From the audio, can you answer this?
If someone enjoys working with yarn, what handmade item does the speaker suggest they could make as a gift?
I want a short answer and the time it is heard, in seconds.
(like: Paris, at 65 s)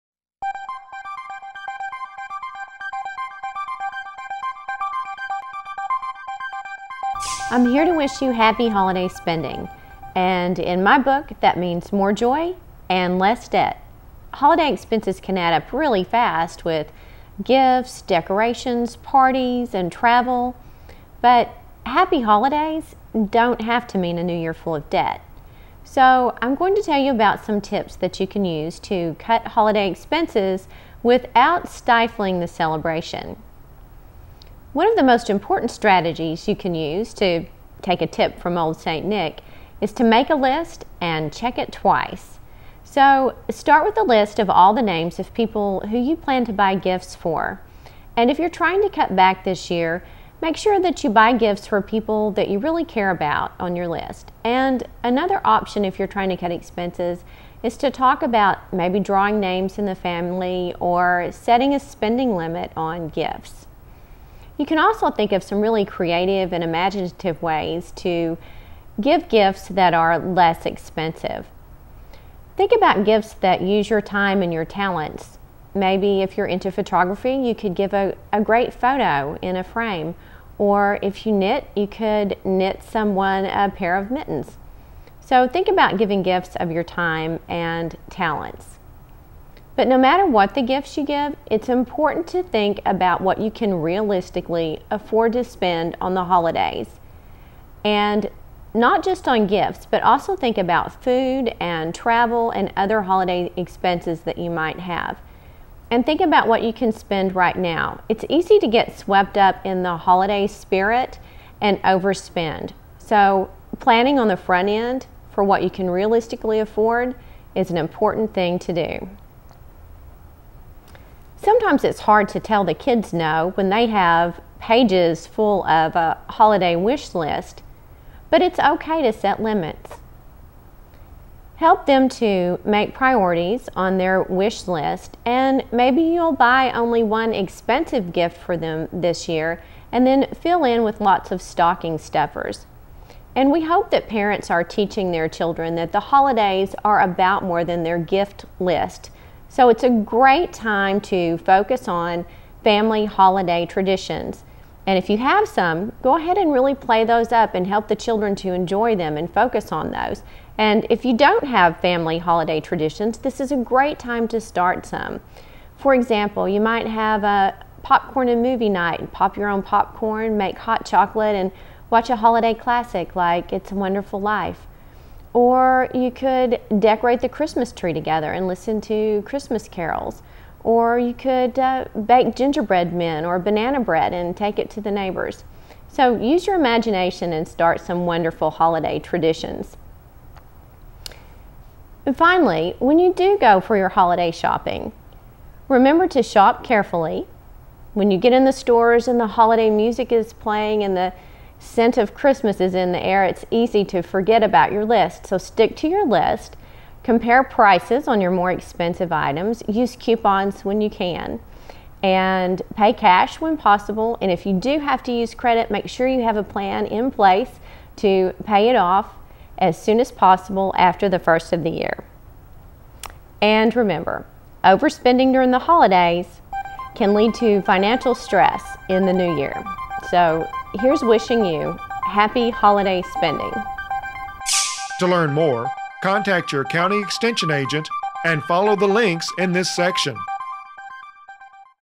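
A pair of mittens, at 83 s.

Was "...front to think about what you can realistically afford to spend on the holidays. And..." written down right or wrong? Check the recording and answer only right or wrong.
wrong.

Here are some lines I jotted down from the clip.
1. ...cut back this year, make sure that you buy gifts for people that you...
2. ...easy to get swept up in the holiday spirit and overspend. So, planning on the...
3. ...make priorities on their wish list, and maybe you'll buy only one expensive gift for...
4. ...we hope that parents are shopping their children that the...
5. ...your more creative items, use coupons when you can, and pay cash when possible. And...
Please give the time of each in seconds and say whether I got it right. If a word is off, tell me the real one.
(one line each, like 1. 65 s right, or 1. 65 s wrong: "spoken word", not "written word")
1. 48 s right
2. 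108 s right
3. 132 s right
4. 143 s wrong: "teaching", not "shopping"
5. 208 s wrong: "expensive", not "creative".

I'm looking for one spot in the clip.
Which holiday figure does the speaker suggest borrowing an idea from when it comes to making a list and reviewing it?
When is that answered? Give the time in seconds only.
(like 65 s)
38 s.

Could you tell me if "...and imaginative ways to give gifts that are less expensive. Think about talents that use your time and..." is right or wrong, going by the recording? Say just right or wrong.
wrong.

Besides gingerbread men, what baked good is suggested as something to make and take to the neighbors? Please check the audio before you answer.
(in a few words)
Banana bread.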